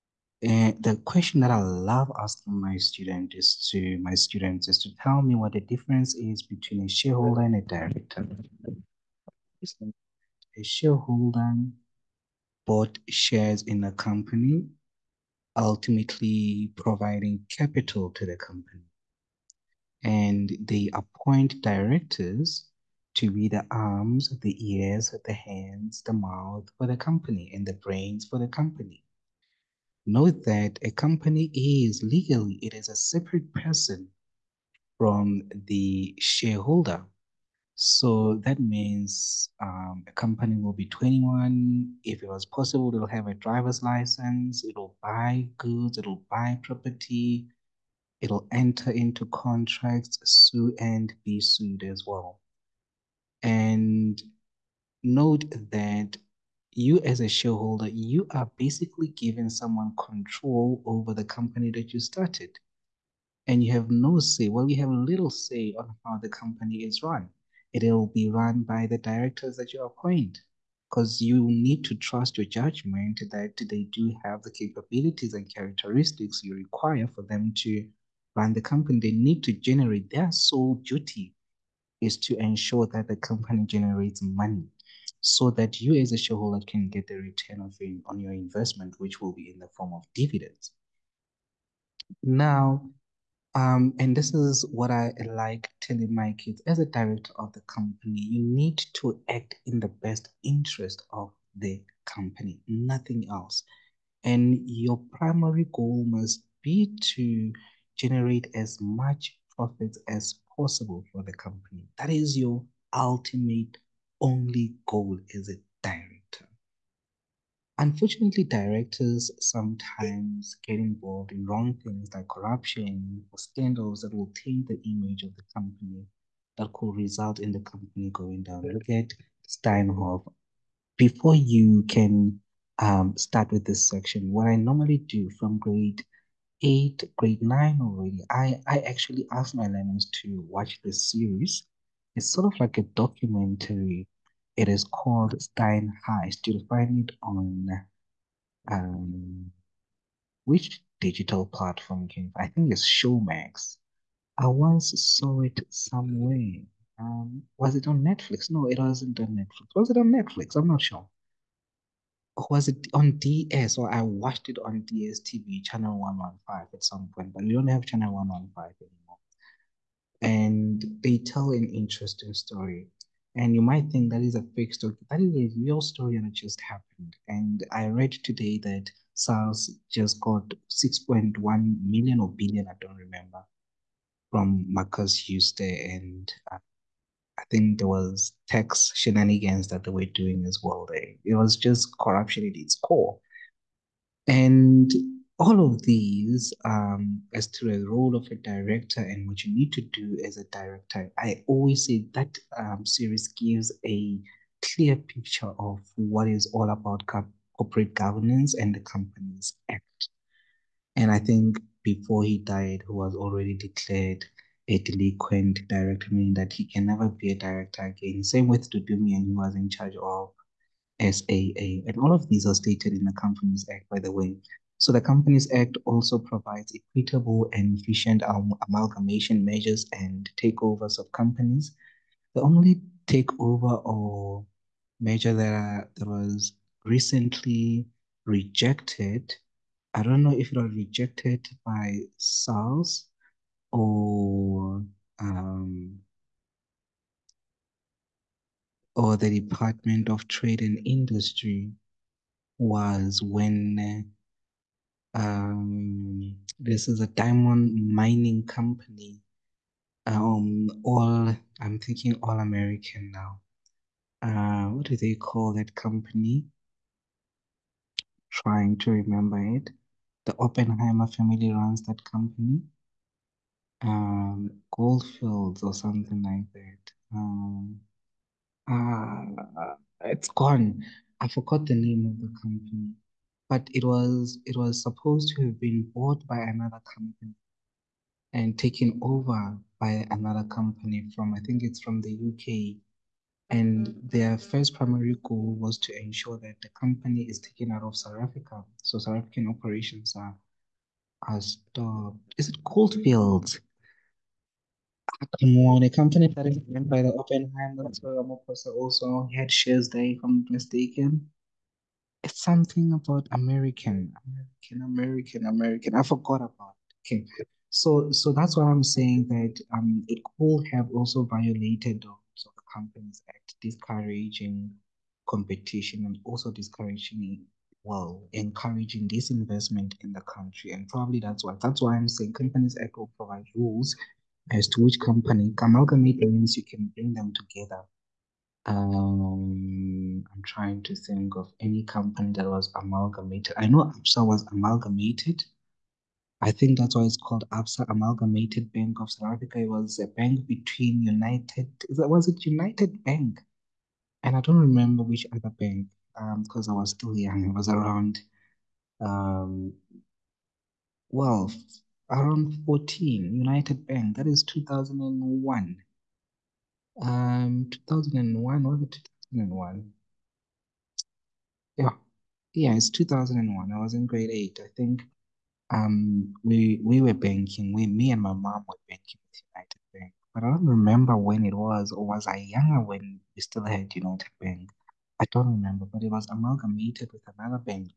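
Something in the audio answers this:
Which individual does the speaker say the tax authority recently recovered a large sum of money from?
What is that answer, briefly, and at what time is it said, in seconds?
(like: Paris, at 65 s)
Markus Jooste, at 184 s.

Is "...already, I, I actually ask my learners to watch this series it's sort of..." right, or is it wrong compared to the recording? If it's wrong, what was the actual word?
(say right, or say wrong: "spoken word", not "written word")
right.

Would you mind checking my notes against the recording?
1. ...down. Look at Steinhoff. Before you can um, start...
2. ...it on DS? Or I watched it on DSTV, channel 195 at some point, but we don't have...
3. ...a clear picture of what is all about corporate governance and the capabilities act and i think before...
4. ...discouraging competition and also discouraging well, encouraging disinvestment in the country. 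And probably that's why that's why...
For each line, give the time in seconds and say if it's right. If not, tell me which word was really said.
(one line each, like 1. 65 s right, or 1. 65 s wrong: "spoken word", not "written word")
1. 128 s right
2. 162 s wrong: "115", not "195"
3. 203 s wrong: "companies", not "capabilities"
4. 323 s right.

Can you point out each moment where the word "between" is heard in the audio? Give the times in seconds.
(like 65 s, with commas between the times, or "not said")
6 s, 350 s.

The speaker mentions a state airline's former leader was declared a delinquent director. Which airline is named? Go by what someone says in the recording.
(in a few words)
SAA.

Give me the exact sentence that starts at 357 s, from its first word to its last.
I was around, um, well, around 14, United Bank.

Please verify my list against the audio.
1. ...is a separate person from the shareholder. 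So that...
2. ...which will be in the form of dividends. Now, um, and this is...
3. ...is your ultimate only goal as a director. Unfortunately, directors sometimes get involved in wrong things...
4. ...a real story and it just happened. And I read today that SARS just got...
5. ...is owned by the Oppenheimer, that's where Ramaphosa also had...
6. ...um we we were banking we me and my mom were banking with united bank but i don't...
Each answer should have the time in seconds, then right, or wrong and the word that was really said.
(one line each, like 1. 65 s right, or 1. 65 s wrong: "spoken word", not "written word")
1. 32 s right
2. 88 s right
3. 112 s right
4. 175 s right
5. 306 s right
6. 375 s right.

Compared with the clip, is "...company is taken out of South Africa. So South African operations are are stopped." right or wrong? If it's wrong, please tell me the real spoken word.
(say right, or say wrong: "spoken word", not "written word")
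right.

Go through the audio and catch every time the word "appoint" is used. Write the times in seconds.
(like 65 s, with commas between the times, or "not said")
20 s, 69 s.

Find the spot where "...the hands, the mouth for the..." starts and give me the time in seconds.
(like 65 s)
25 s.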